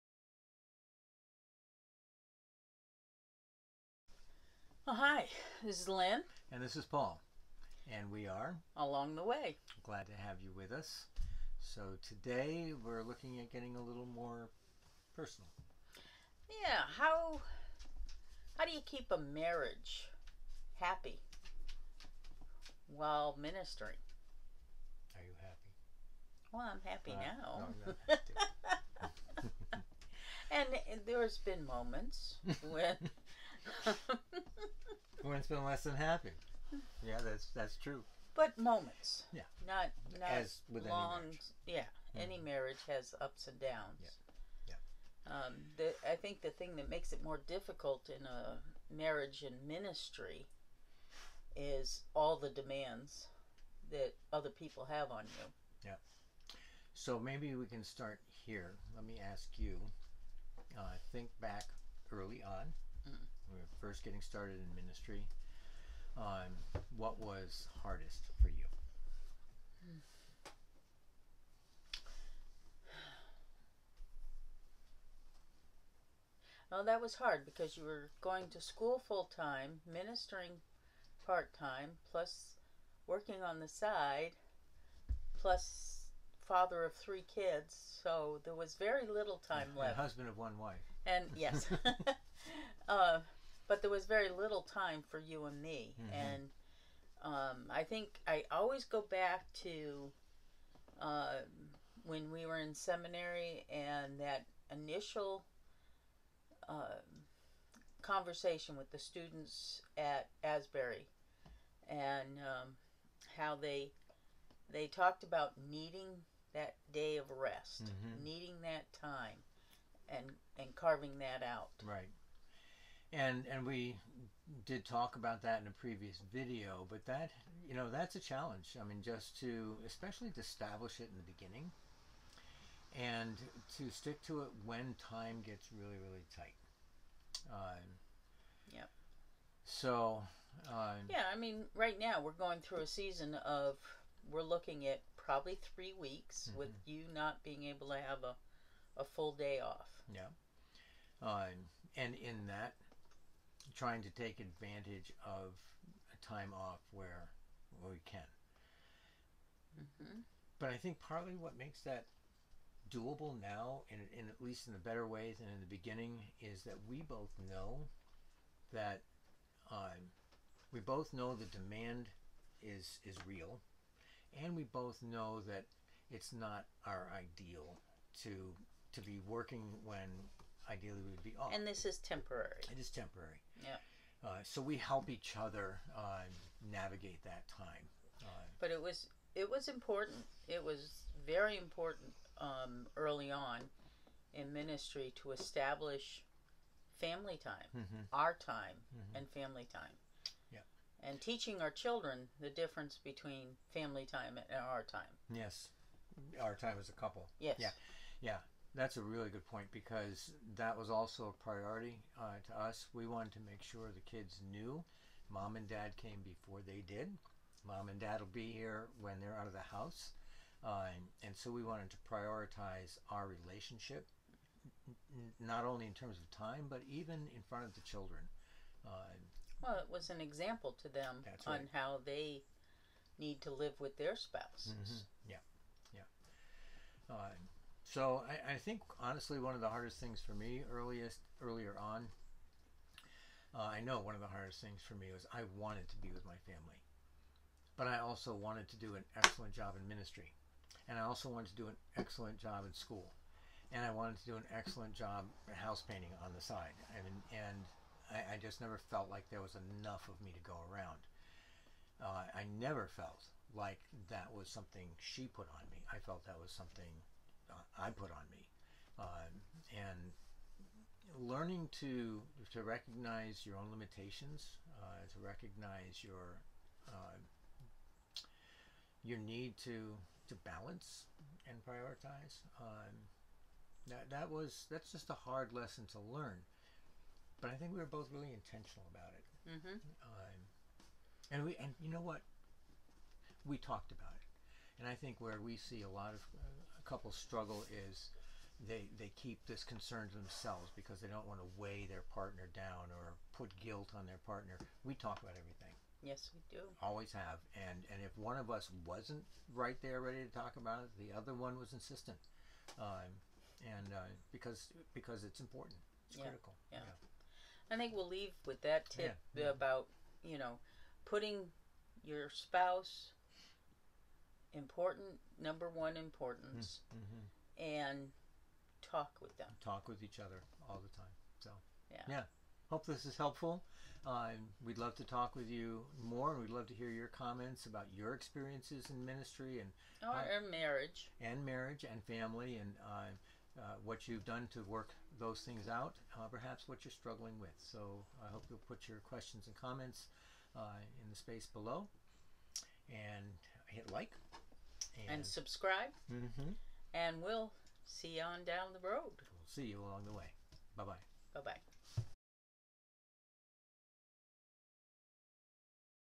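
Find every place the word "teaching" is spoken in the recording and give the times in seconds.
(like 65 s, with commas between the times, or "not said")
201 s.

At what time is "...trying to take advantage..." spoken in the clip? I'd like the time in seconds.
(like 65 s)
153 s.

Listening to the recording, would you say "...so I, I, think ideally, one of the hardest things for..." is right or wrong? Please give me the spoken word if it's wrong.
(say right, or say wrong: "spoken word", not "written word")
wrong: "honestly", not "ideally".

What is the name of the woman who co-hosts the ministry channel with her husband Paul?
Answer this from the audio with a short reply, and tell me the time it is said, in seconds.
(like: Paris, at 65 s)
Lynn, at 5 s.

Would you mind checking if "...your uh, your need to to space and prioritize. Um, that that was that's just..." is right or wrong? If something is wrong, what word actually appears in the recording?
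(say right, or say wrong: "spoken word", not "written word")
wrong: "balance", not "space".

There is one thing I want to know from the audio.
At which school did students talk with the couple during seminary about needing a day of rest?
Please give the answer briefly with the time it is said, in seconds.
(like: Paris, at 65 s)
Asbury, at 110 s.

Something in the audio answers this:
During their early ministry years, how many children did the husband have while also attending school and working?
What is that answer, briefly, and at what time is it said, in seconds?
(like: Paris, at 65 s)
3, at 86 s.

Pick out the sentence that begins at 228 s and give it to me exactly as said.
Uh, well, it was an example to them right.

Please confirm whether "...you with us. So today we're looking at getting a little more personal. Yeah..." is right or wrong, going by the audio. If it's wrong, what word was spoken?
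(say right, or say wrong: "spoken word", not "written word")
right.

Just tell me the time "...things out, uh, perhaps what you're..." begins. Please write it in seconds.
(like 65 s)
345 s.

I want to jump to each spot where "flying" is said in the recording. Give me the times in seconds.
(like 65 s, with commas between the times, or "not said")
not said.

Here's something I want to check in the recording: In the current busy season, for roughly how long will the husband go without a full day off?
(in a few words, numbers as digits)
3 weeks.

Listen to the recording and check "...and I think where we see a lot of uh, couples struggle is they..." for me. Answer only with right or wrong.
right.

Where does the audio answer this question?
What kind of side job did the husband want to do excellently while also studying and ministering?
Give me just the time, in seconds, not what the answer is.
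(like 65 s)
255 s.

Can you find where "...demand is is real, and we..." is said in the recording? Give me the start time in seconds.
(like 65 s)
171 s.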